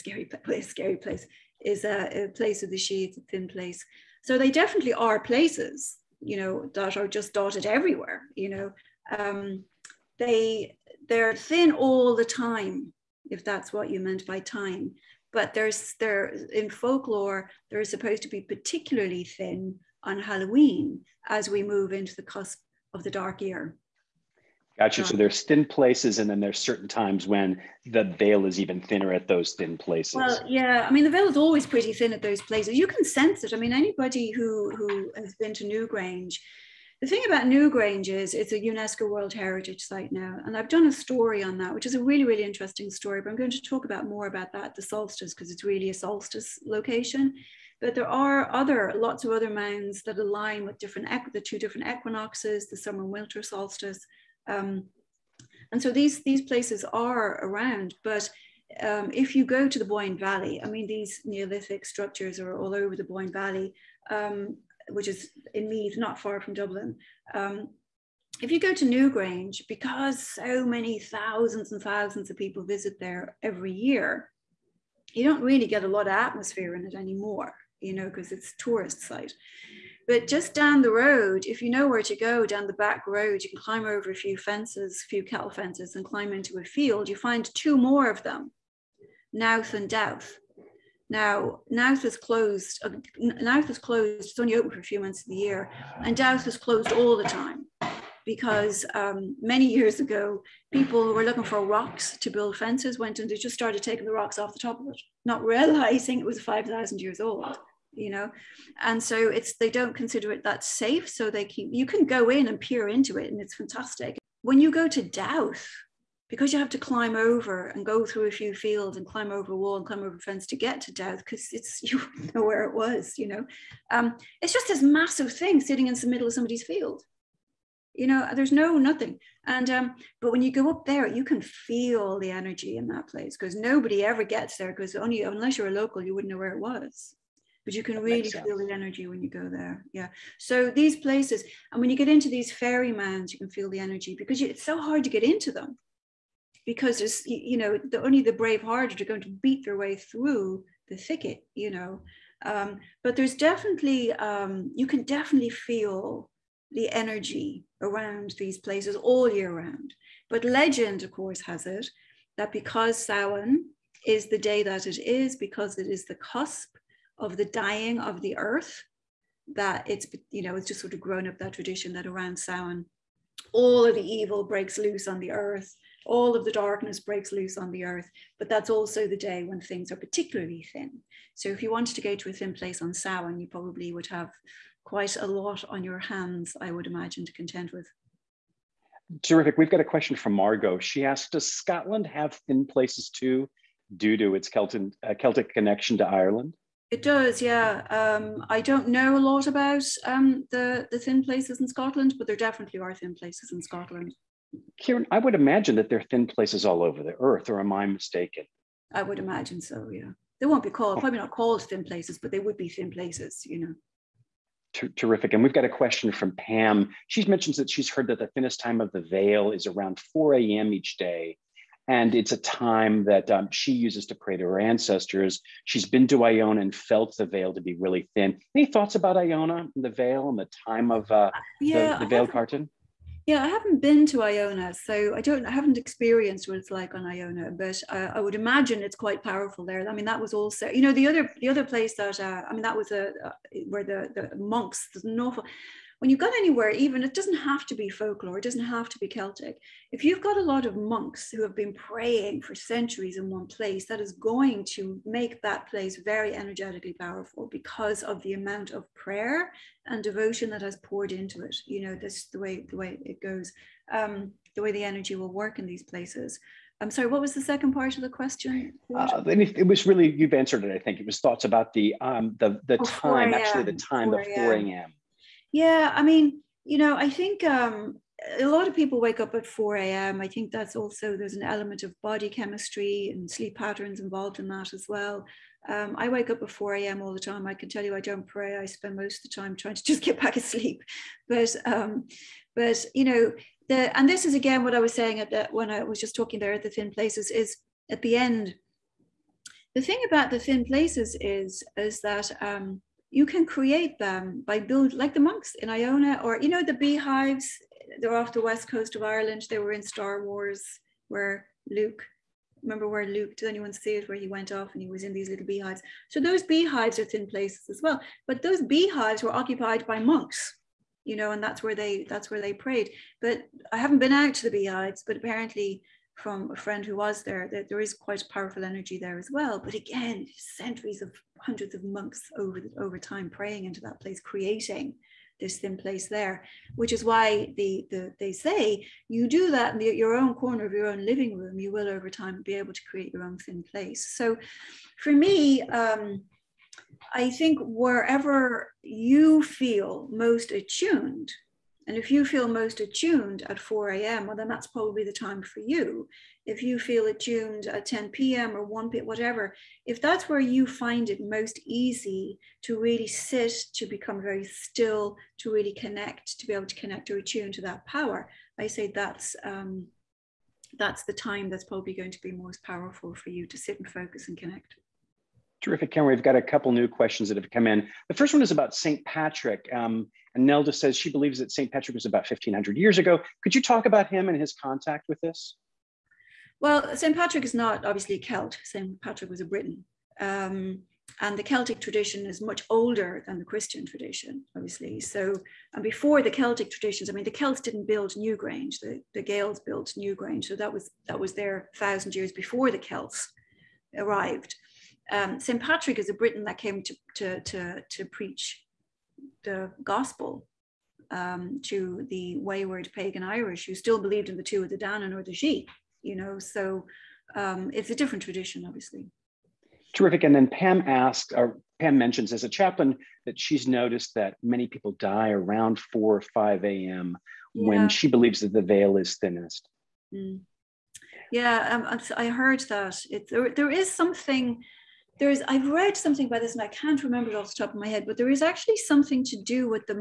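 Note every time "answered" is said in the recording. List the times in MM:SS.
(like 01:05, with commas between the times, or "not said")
04:30.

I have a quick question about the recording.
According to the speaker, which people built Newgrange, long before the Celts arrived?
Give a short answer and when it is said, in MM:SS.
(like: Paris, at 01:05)
The Gaels, at 06:39.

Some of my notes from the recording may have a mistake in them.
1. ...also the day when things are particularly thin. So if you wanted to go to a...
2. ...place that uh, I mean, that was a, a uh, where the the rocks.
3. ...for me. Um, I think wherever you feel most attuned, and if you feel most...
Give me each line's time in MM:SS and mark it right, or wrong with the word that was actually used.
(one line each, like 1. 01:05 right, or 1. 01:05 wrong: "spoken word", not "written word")
1. 02:58 right
2. 04:01 wrong: "monks", not "rocks"
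3. 05:45 right.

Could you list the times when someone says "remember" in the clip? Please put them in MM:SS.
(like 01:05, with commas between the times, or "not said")
05:12, 07:17.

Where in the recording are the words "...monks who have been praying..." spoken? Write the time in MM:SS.
04:10.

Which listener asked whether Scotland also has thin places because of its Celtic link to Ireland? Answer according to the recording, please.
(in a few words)
Margot.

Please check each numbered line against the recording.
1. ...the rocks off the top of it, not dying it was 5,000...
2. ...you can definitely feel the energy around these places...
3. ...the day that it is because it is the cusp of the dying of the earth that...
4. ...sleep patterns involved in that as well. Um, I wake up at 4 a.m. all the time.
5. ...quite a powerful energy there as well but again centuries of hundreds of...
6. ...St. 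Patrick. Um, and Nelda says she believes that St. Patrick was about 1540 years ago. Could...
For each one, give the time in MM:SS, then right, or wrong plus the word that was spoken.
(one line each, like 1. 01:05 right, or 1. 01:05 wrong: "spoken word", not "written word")
1. 01:44 wrong: "realizing", not "dying"
2. 02:34 right
3. 02:44 right
4. 04:43 right
5. 05:27 right
6. 06:18 wrong: "1500", not "1540".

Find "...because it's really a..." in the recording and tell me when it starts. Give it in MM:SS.
00:45.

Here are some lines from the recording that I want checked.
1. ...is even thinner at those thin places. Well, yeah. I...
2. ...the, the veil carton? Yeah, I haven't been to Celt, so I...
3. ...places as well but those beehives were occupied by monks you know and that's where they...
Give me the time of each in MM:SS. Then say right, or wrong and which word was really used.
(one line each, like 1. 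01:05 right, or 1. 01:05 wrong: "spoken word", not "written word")
1. 00:28 right
2. 03:51 wrong: "Iona", not "Celt"
3. 05:17 right.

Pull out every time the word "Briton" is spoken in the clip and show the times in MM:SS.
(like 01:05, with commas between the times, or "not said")
06:29, 06:46.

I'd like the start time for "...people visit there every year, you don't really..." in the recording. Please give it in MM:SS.
01:12.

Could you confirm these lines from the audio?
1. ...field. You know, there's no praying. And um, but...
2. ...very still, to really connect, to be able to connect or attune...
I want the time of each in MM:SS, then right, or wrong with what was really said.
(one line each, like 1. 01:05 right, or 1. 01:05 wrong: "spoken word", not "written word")
1. 02:06 wrong: "nothing", not "praying"
2. 06:04 right.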